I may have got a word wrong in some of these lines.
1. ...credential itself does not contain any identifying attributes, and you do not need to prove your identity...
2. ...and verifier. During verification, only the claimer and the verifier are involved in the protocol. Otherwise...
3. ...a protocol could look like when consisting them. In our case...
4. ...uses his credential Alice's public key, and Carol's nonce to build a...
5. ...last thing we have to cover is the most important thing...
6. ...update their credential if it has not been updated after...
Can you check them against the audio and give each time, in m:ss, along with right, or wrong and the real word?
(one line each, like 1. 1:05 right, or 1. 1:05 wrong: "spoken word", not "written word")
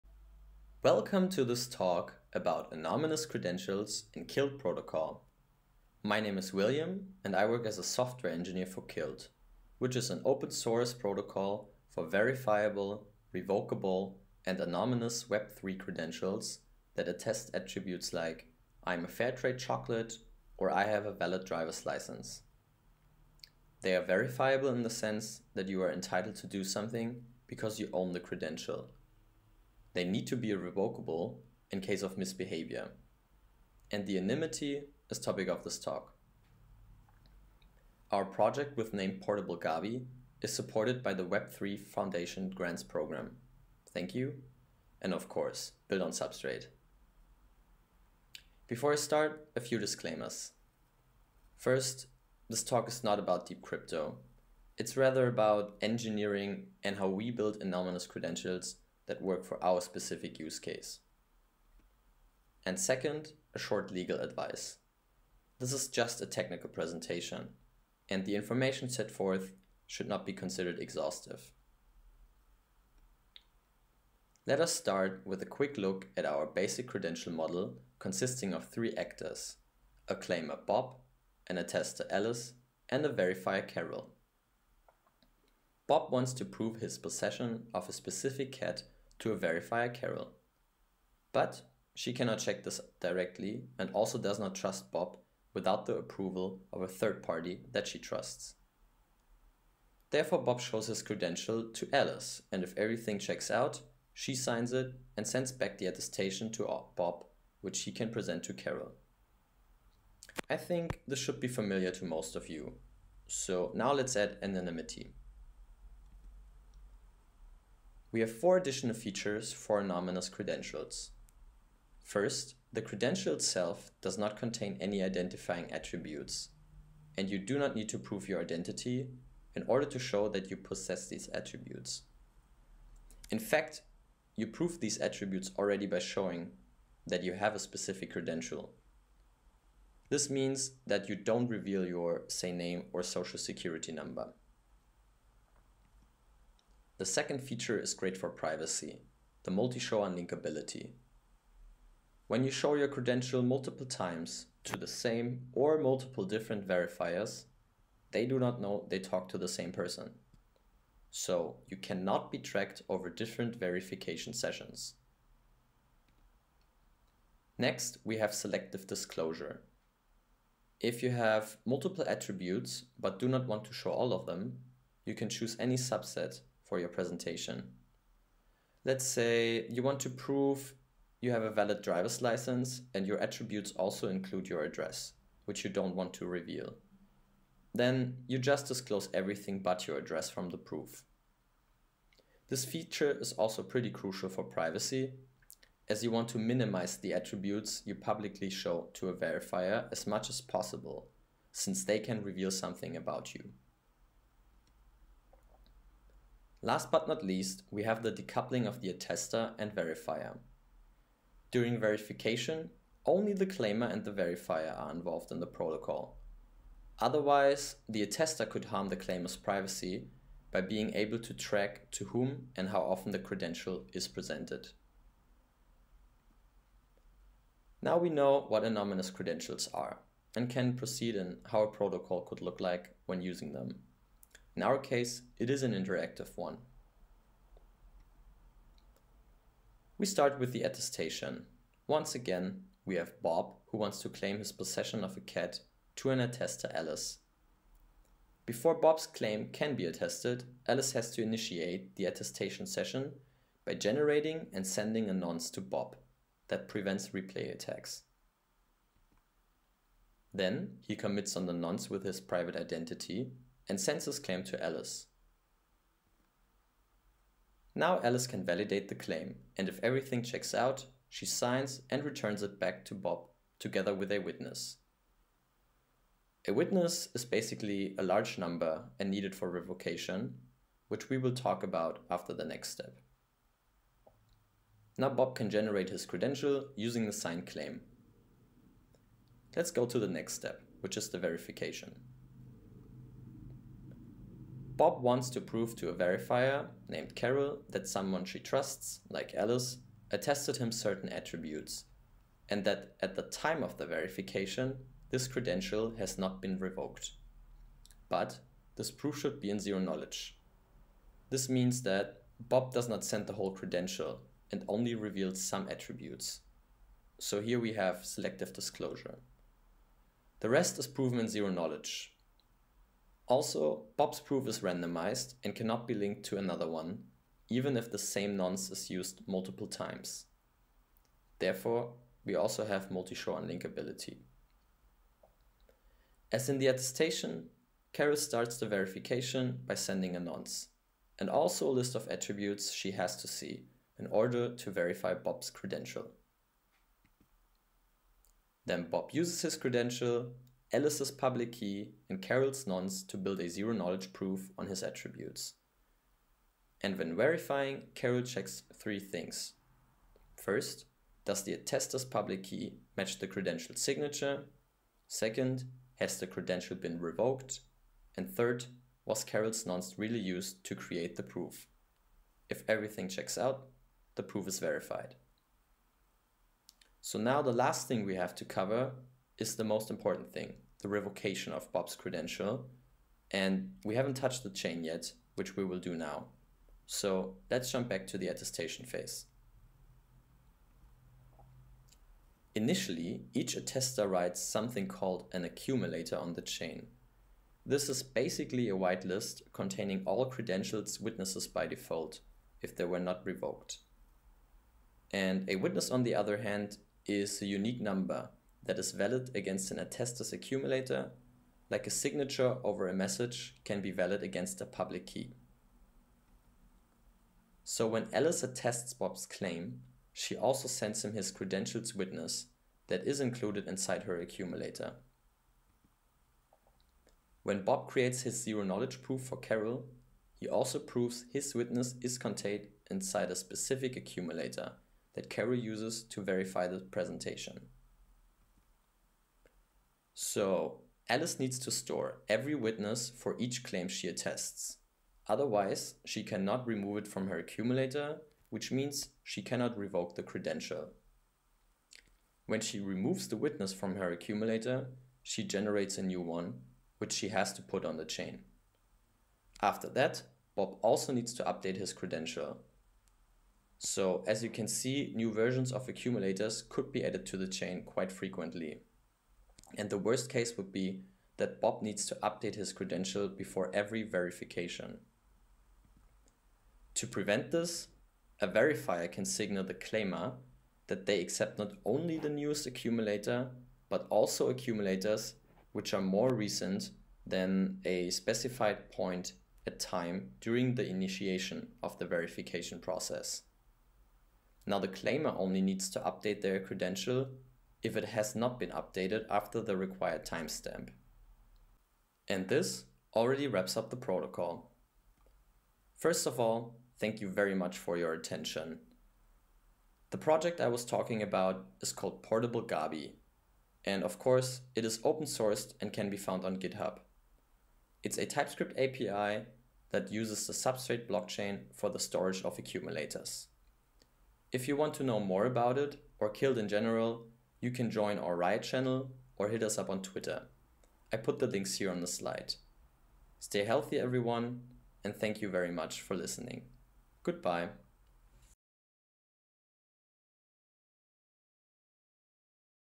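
1. 2:02 right
2. 3:29 right
3. 3:51 wrong: "using", not "consisting"
4. 5:49 right
5. 6:17 right
6. 8:16 right.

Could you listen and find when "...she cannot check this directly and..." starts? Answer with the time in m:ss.
1:31.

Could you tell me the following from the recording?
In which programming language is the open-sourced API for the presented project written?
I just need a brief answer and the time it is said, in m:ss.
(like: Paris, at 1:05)
TypeScript, at 8:38.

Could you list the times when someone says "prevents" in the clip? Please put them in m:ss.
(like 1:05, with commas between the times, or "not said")
4:16, 7:57.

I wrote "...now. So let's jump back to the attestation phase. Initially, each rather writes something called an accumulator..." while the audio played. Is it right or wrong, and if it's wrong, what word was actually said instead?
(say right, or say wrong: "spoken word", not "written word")
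wrong: "attester", not "rather".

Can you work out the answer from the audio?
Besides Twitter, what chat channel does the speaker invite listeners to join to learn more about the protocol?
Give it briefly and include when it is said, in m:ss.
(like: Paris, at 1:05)
Riot, at 8:48.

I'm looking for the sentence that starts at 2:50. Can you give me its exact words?
If you have multiple attributes but do not want to show all of them, you can choose any subset for your presentation.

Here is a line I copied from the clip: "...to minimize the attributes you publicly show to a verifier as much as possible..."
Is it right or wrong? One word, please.
right.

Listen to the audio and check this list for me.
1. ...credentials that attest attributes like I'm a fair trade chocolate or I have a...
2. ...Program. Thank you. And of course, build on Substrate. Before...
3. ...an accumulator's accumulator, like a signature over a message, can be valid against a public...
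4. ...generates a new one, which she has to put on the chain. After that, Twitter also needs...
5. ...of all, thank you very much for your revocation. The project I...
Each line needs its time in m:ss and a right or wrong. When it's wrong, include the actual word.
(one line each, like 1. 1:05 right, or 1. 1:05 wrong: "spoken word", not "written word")
1. 0:15 right
2. 0:42 right
3. 6:49 wrong: "attestor", not "accumulator"
4. 7:35 wrong: "Bob", not "Twitter"
5. 8:26 wrong: "attention", not "revocation".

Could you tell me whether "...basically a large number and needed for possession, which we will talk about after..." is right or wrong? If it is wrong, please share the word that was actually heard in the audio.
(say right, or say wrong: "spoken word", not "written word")
wrong: "revocation", not "possession".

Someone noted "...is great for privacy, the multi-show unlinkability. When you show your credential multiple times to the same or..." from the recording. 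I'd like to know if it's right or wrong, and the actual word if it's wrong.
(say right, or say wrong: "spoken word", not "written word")
right.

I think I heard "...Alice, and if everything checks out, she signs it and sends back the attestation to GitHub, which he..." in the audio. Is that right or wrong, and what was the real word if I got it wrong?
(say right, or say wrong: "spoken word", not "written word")
wrong: "Bob", not "GitHub".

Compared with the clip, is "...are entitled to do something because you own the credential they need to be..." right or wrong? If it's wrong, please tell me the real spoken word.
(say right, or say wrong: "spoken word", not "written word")
right.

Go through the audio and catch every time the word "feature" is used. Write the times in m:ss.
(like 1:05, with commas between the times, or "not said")
1:58, 2:27, 3:12.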